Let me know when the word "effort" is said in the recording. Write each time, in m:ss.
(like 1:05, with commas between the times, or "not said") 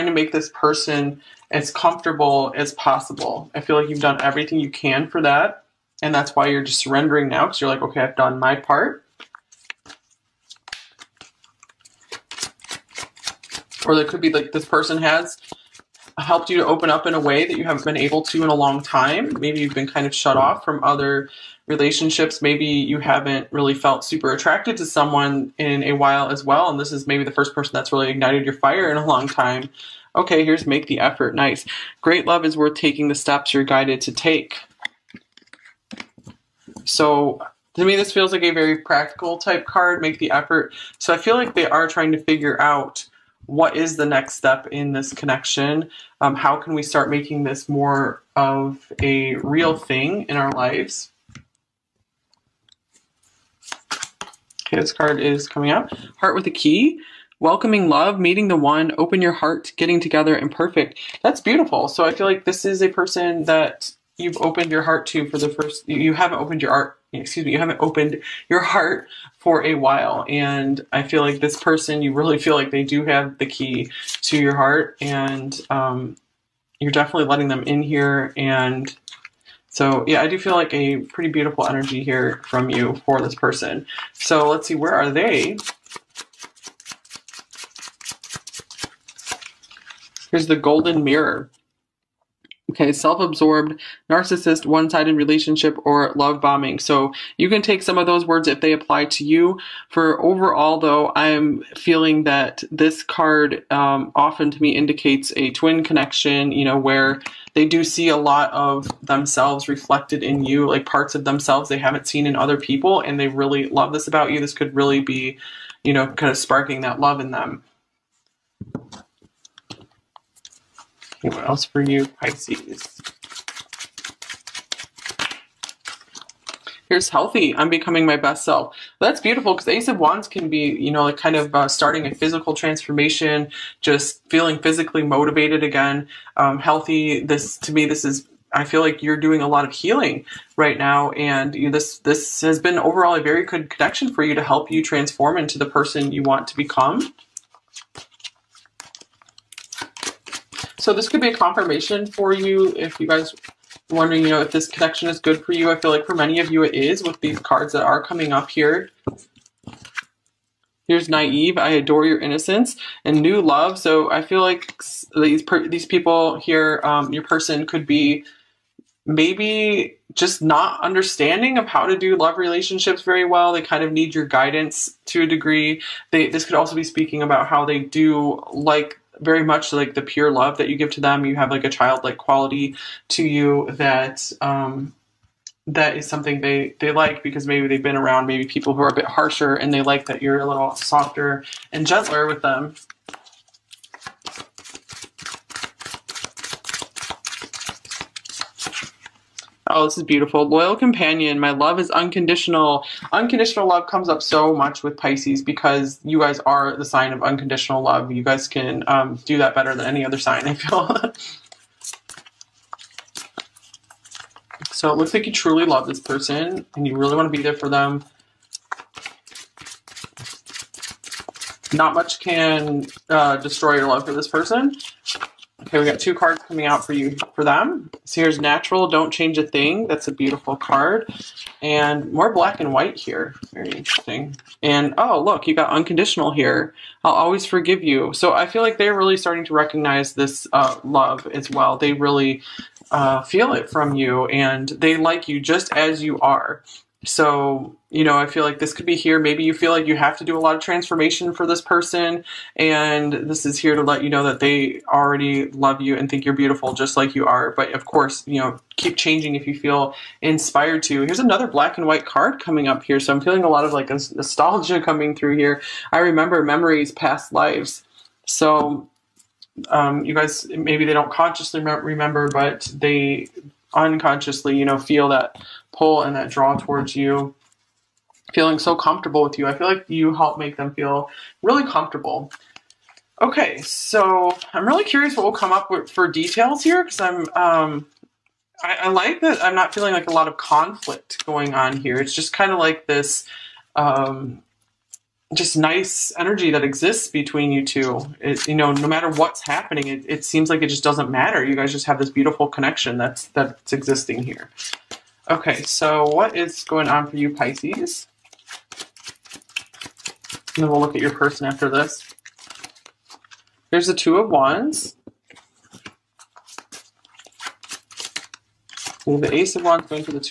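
0:30, 0:40.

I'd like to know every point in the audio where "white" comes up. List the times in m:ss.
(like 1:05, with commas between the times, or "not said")
3:52, 4:21.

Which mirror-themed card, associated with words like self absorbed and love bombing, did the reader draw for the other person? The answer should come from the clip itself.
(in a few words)
The golden mirror.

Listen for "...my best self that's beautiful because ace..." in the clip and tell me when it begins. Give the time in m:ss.
2:08.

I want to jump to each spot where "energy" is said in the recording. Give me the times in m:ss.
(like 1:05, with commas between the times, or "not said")
1:21, 4:56.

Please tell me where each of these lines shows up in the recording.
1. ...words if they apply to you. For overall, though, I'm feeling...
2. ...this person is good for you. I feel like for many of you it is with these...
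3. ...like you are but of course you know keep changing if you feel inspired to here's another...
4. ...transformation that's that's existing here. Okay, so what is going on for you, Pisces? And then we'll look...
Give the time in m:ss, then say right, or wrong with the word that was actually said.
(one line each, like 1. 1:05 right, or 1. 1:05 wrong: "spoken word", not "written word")
1. 1:38 right
2. 2:34 wrong: "connection", not "person"
3. 4:16 right
4. 5:02 wrong: "connection", not "transformation".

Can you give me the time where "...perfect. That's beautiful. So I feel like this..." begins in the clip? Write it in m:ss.
1:00.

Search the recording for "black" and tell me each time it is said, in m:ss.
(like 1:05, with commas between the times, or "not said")
3:52, 4:21.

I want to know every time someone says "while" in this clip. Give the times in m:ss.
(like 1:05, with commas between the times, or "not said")
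0:25, 1:09.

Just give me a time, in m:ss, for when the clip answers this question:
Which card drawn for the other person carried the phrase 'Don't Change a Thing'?
3:48.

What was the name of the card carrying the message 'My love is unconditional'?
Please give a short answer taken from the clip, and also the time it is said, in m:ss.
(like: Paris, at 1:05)
Loyal companion, at 3:20.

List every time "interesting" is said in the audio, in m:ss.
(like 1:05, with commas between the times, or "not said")
3:53.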